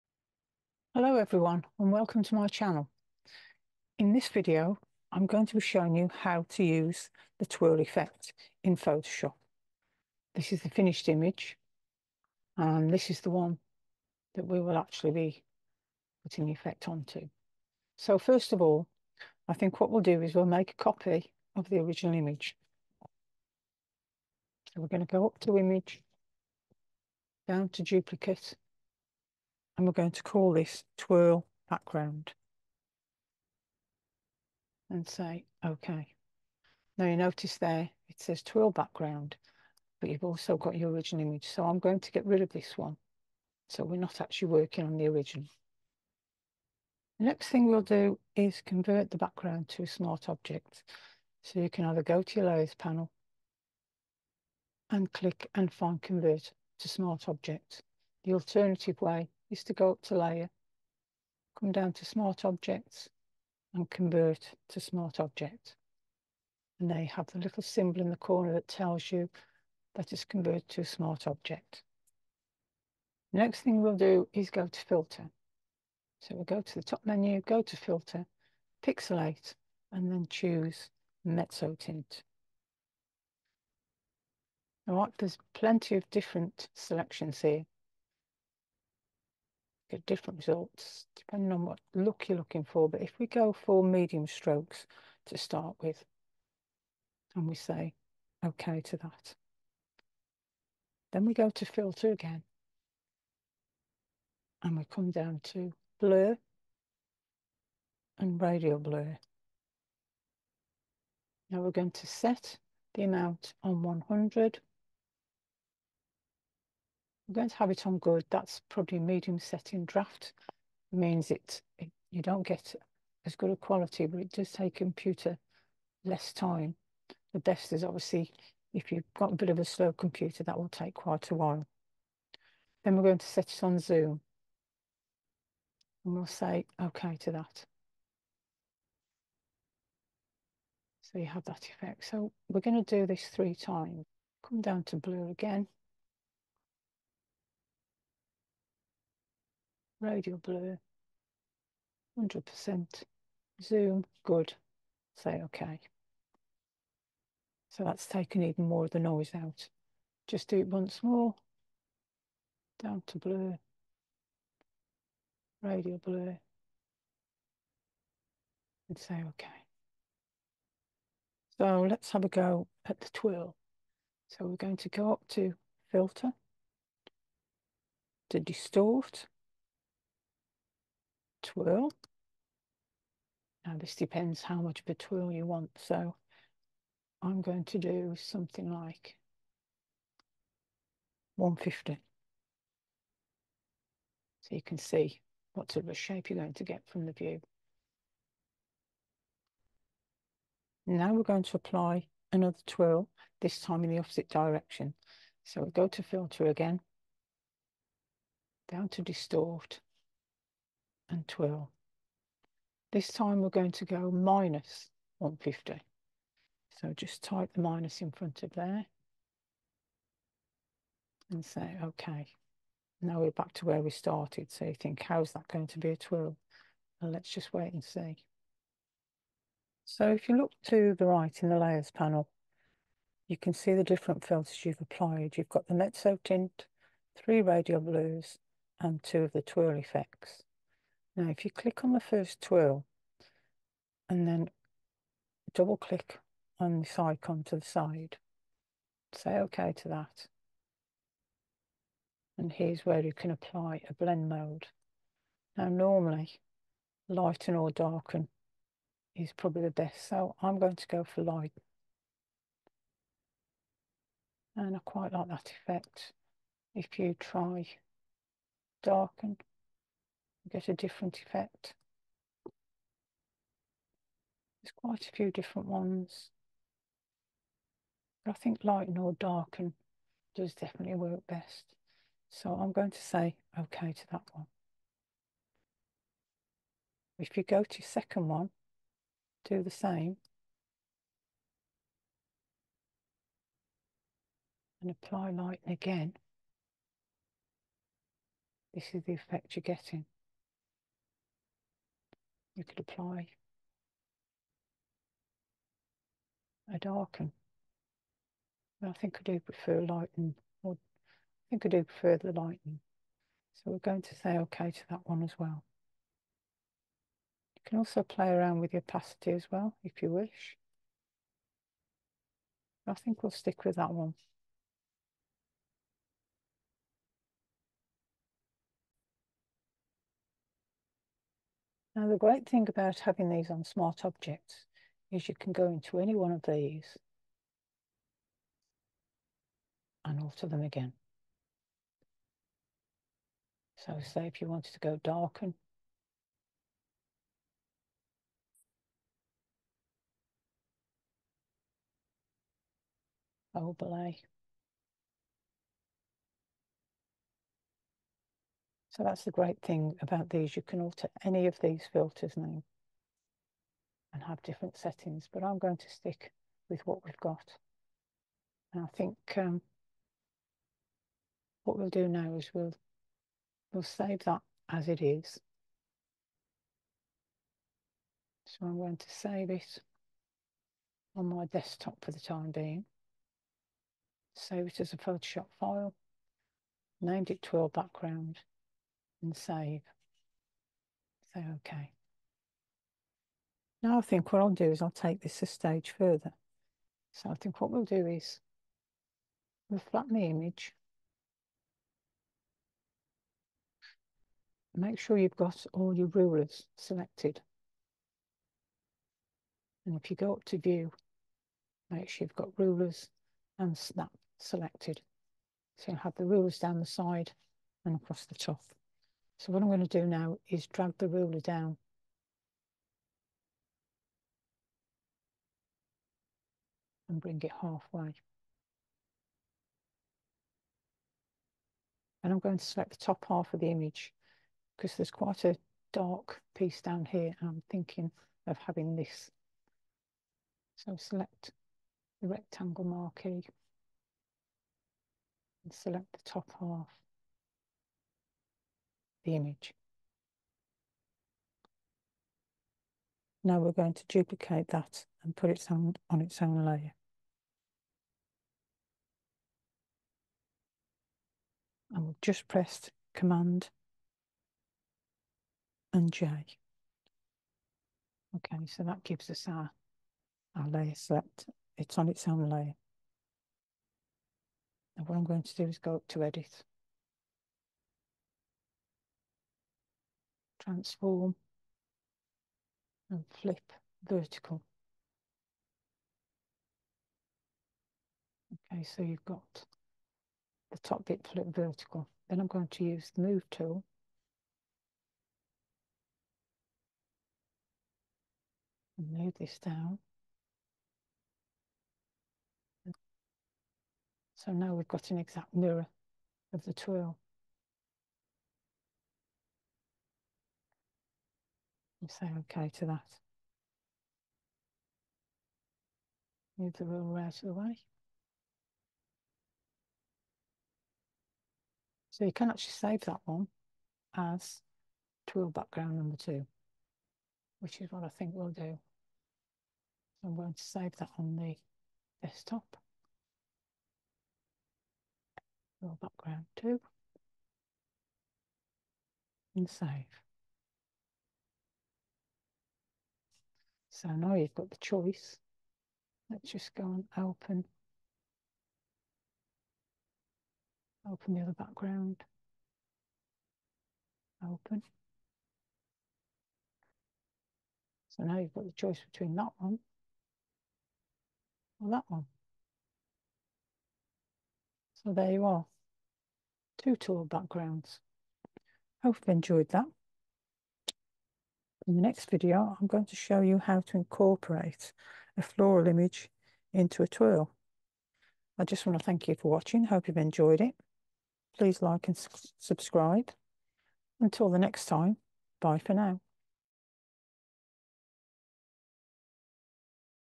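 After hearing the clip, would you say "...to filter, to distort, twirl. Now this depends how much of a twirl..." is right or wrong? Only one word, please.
right.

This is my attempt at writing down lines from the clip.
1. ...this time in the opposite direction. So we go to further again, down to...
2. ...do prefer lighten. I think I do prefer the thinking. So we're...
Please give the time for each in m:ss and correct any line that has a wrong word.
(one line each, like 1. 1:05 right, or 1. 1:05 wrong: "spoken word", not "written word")
1. 3:23 wrong: "filter", not "further"
2. 5:09 wrong: "lightning", not "thinking".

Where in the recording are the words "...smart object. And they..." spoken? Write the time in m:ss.
1:04.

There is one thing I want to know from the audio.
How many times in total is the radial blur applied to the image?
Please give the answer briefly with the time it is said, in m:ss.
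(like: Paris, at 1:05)
3, at 2:23.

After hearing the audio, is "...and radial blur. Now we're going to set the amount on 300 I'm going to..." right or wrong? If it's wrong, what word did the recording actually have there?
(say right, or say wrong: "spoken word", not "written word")
wrong: "100", not "300".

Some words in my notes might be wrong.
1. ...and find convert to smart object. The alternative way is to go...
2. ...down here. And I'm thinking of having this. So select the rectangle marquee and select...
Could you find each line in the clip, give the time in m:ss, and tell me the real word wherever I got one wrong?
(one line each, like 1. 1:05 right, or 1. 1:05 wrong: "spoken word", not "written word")
1. 0:55 right
2. 7:16 right.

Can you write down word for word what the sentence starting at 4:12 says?
And here's where you can apply a blend mode.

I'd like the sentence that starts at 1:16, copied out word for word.
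So we'll go to the top menu, go to filter, pixelate, and then choose Mezzotint.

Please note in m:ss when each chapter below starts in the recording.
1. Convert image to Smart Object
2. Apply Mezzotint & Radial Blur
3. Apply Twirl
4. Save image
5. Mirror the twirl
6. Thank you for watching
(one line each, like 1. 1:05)
1. 0:46
2. 1:13
3. 2:51
4. 6:09
5. 6:33
6. 9:29.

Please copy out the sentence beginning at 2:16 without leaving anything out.
And we'll say OK to that.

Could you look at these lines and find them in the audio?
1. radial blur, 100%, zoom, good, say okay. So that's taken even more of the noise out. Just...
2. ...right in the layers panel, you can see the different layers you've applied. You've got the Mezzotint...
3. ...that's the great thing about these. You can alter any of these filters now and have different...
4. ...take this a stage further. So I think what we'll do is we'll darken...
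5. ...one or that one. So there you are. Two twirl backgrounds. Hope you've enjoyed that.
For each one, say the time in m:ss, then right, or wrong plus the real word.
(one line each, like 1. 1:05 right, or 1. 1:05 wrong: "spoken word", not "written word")
1. 2:30 right
2. 3:51 wrong: "filters", not "layers"
3. 5:59 right
4. 6:34 wrong: "flatten", not "darken"
5. 9:19 right.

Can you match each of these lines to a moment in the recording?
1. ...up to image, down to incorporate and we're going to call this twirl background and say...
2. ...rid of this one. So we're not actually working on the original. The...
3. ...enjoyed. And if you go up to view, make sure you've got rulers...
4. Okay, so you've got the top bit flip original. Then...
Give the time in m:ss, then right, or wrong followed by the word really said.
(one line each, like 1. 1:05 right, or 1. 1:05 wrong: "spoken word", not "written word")
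1. 0:25 wrong: "duplicate", not "incorporate"
2. 0:42 right
3. 6:46 wrong: "selected", not "enjoyed"
4. 8:08 wrong: "vertical", not "original".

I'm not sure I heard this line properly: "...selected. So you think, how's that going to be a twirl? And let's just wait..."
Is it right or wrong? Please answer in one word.
wrong.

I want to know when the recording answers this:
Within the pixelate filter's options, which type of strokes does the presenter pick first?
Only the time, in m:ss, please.
1:33.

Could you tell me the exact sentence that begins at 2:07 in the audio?
The best is obviously if you've got a bit of a slow computer, that will take quite a while.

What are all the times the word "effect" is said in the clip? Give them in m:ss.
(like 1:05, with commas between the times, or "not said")
0:07, 0:16, 2:21, 3:59, 4:25, 4:31, 4:59.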